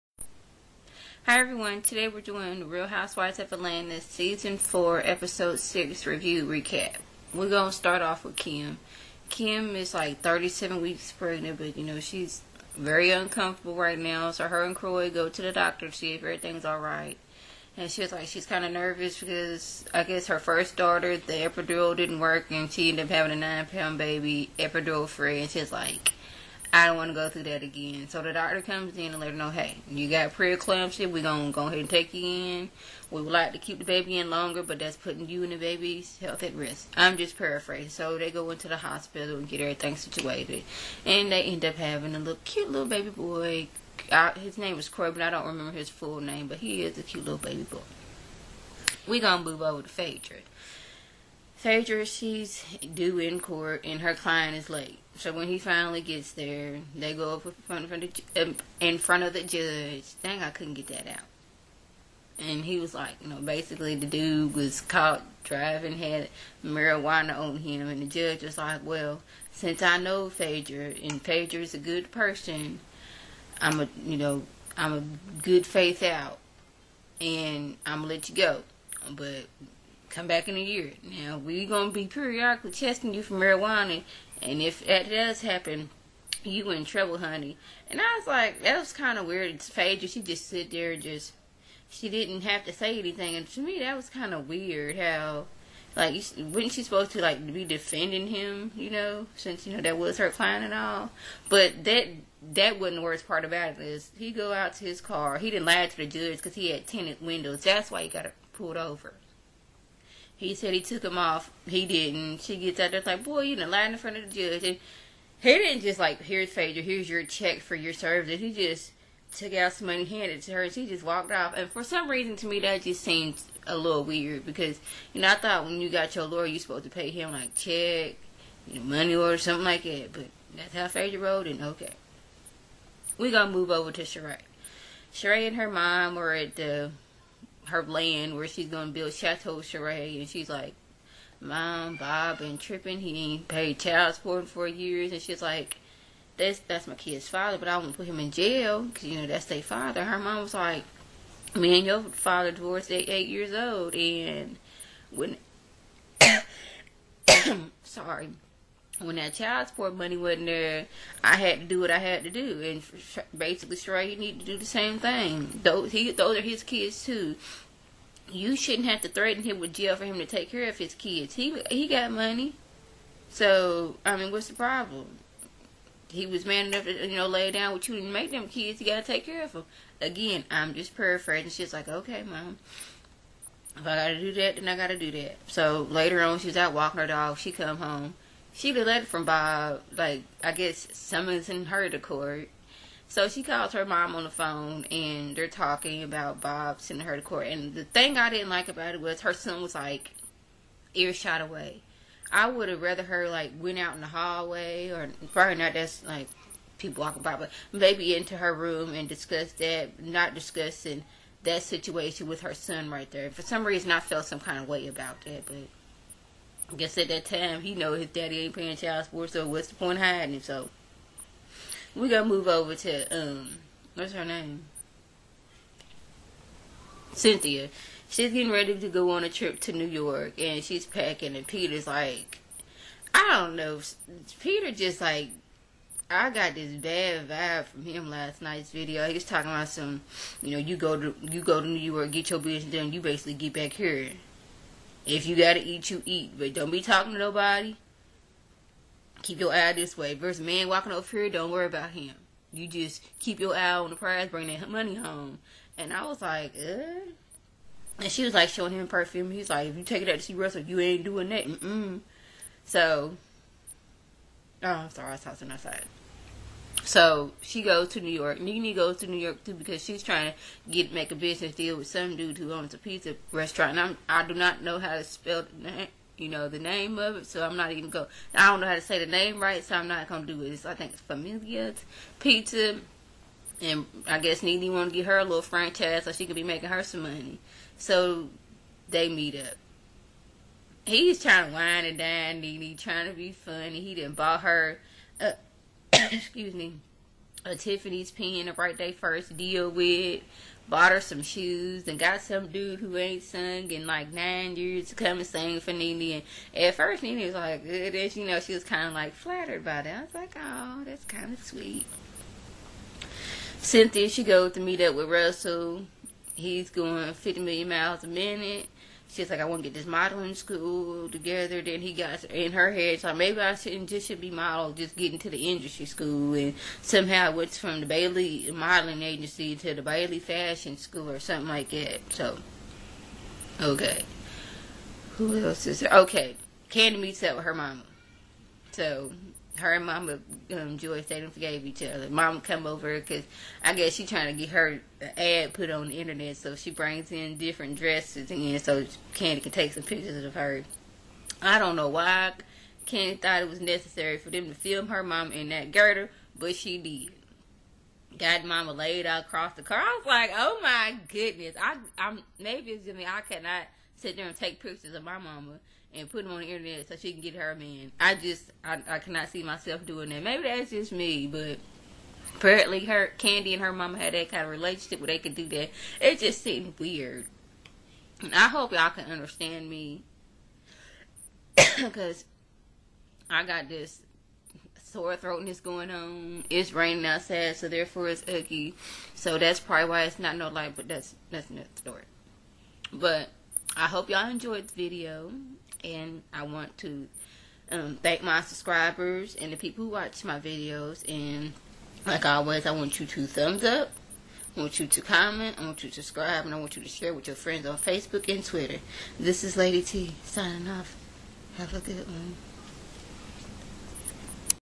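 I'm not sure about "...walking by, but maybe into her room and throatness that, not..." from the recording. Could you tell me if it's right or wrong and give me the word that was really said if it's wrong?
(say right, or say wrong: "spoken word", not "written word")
wrong: "discuss", not "throatness".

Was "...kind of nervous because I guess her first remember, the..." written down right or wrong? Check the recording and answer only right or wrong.
wrong.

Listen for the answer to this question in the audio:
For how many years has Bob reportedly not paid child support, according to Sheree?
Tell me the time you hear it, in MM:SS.
02:24.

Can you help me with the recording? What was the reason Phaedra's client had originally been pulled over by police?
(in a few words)
Tinted windows.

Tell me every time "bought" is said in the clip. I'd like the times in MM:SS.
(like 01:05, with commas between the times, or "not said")
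04:54, 05:00.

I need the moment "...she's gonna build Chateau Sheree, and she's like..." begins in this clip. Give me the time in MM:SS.
02:18.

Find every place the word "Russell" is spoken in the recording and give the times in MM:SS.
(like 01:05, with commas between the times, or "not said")
04:20, 05:15.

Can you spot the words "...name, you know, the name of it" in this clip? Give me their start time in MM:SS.
04:35.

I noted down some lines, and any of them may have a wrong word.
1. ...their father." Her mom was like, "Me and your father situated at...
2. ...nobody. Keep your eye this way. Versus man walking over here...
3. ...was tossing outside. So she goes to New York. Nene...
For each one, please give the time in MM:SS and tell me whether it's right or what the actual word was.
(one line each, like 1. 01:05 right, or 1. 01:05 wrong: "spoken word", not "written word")
1. 02:29 wrong: "divorced", not "situated"
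2. 04:07 right
3. 04:25 right.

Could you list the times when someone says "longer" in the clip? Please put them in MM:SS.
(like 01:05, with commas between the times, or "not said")
00:34.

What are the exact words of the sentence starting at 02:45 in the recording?
Those he, those are his kids too.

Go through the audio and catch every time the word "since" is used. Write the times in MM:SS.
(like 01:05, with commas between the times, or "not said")
01:09, 01:39.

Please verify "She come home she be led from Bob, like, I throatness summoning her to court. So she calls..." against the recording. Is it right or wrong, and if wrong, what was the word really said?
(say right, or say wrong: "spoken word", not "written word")
wrong: "guess", not "throatness".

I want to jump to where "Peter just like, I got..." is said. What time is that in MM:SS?
03:54.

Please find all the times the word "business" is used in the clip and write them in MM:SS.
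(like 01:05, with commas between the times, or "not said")
04:02, 04:31.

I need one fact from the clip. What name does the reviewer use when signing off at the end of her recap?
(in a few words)
Lady T.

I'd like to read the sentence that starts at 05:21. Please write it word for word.
Then he got in her head, so maybe I shouldn't just should be model, just getting to the industry school.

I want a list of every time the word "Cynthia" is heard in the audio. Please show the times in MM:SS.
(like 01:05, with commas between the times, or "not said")
03:47, 05:13.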